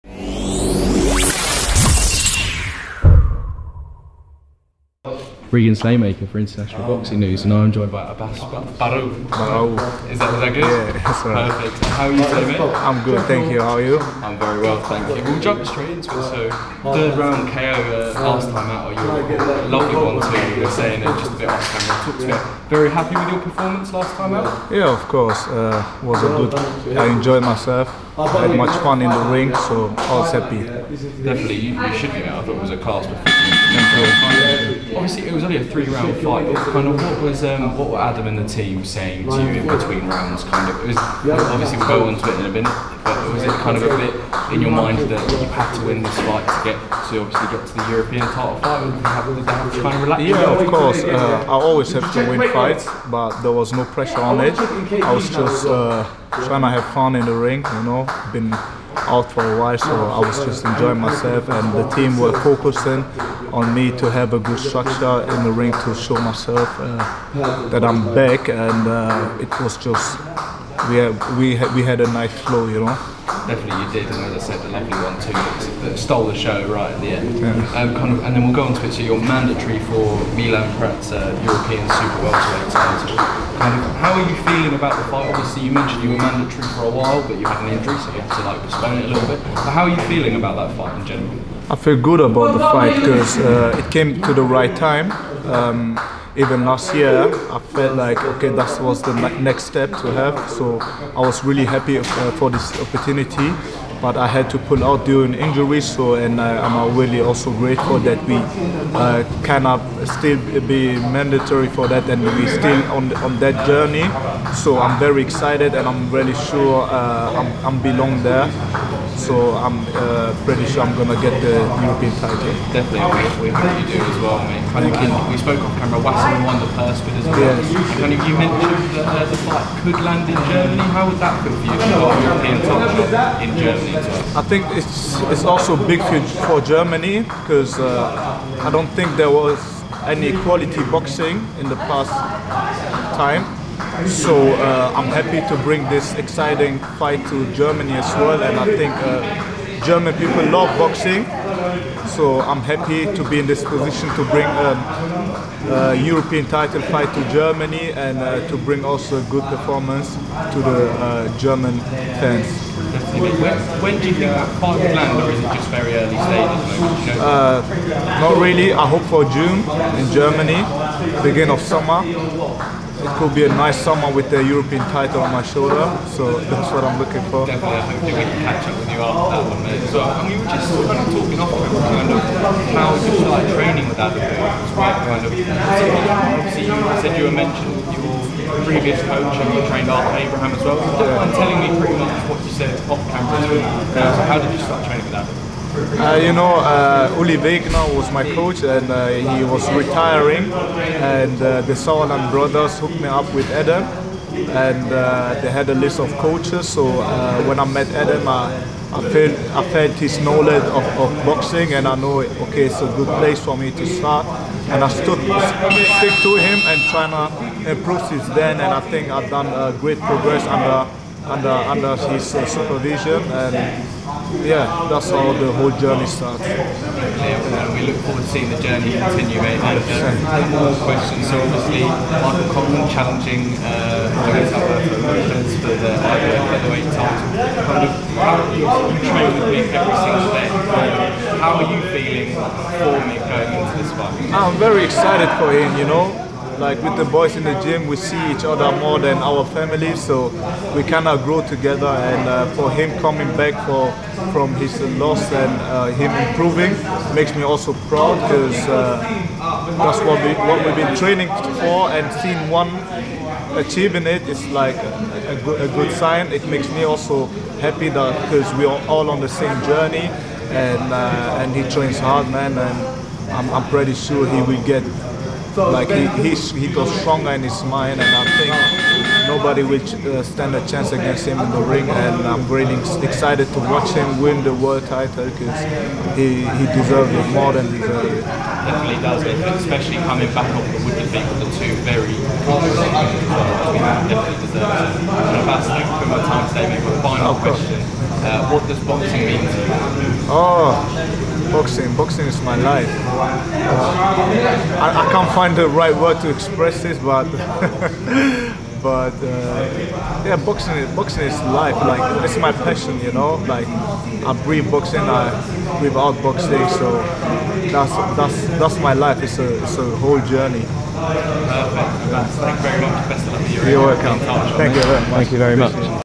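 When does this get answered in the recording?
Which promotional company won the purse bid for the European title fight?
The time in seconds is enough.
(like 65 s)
126 s.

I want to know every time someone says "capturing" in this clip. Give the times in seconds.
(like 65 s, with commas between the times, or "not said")
not said.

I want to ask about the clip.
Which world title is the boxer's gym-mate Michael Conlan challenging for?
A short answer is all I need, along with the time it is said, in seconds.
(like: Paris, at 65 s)
IBF featherweight title, at 235 s.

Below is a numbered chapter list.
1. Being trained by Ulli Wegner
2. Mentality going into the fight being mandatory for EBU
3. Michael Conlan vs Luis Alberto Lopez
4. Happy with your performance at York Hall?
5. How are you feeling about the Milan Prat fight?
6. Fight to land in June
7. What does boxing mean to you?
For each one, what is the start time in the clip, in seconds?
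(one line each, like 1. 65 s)
1. 196 s
2. 50 s
3. 245 s
4. 24 s
5. 91 s
6. 168 s
7. 300 s.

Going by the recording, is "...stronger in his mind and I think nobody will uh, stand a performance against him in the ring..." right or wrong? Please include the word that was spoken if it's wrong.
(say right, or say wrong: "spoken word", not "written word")
wrong: "chance", not "performance".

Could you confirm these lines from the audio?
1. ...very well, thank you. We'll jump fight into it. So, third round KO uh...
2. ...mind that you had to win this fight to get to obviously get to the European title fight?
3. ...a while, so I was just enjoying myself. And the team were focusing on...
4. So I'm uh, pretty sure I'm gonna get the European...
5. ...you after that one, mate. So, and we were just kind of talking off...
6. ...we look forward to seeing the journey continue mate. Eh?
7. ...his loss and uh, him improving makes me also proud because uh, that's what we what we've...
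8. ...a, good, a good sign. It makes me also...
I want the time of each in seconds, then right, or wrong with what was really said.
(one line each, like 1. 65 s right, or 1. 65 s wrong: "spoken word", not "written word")
1. 14 s wrong: "straight", not "fight"
2. 44 s right
3. 59 s right
4. 119 s right
5. 178 s right
6. 227 s right
7. 254 s right
8. 265 s right.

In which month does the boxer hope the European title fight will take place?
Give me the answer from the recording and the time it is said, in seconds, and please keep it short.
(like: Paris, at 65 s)
June, at 169 s.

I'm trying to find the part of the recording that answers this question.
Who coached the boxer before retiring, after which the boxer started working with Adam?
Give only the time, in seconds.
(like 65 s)
197 s.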